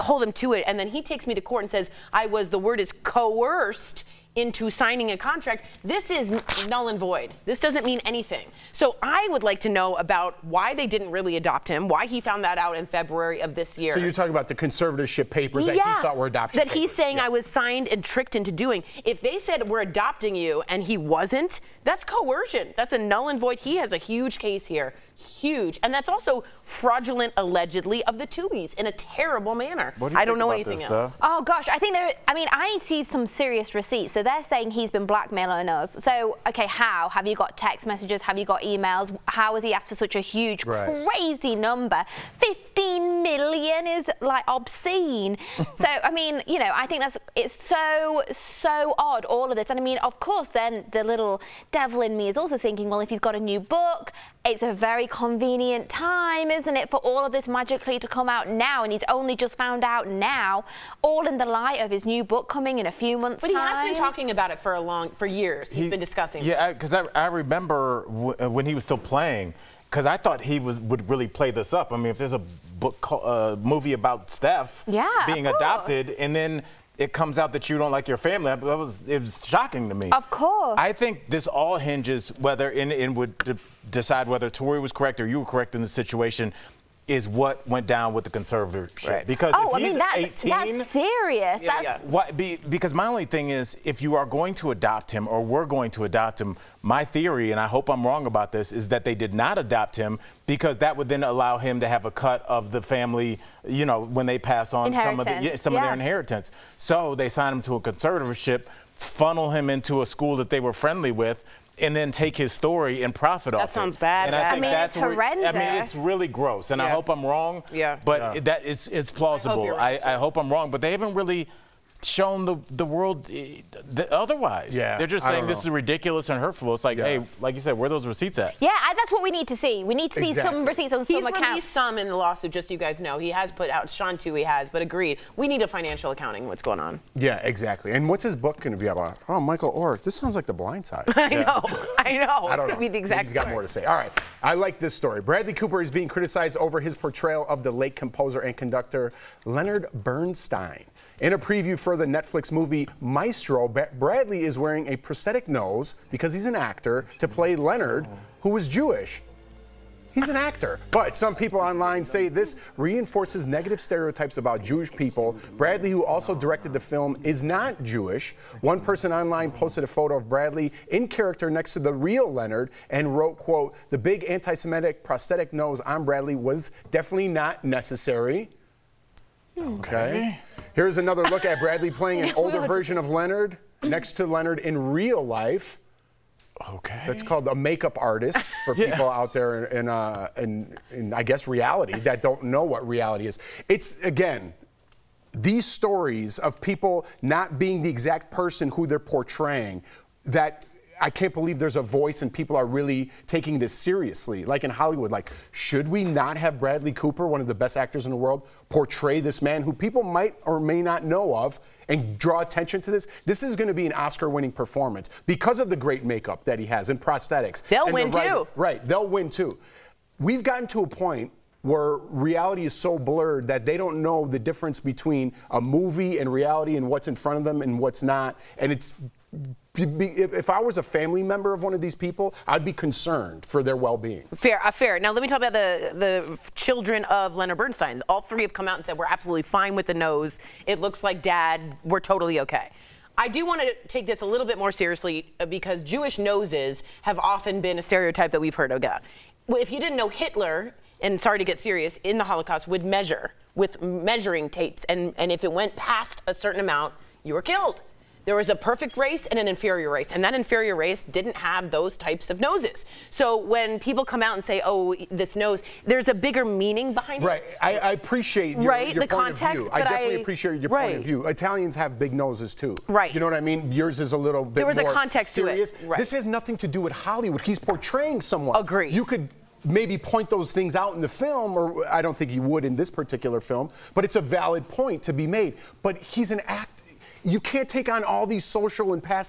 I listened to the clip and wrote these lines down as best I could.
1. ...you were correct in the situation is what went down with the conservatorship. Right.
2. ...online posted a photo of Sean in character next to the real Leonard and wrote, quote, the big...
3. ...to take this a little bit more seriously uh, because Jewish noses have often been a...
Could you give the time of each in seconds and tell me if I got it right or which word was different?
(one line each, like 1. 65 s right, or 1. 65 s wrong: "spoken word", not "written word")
1. 85 s right
2. 169 s wrong: "Bradley", not "Sean"
3. 243 s right.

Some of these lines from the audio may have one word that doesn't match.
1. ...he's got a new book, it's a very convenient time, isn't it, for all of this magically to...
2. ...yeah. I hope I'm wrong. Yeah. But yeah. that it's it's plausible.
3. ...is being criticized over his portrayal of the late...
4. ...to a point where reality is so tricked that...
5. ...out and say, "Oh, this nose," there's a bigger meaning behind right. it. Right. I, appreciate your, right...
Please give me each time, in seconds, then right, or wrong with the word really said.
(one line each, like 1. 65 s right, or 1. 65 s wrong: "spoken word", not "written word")
1. 53 s right
2. 116 s right
3. 145 s right
4. 220 s wrong: "blurred", not "tricked"
5. 264 s right.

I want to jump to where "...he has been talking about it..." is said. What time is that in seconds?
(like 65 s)
63 s.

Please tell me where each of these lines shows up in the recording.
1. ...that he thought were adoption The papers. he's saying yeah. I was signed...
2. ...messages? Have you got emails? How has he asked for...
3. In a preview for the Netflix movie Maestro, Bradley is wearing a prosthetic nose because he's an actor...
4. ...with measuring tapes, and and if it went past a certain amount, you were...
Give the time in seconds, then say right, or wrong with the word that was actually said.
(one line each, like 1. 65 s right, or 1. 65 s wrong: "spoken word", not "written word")
1. 15 s wrong: "That", not "The"
2. 37 s right
3. 151 s right
4. 253 s right.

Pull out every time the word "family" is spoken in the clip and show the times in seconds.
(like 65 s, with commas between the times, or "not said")
78 s, 102 s, 230 s.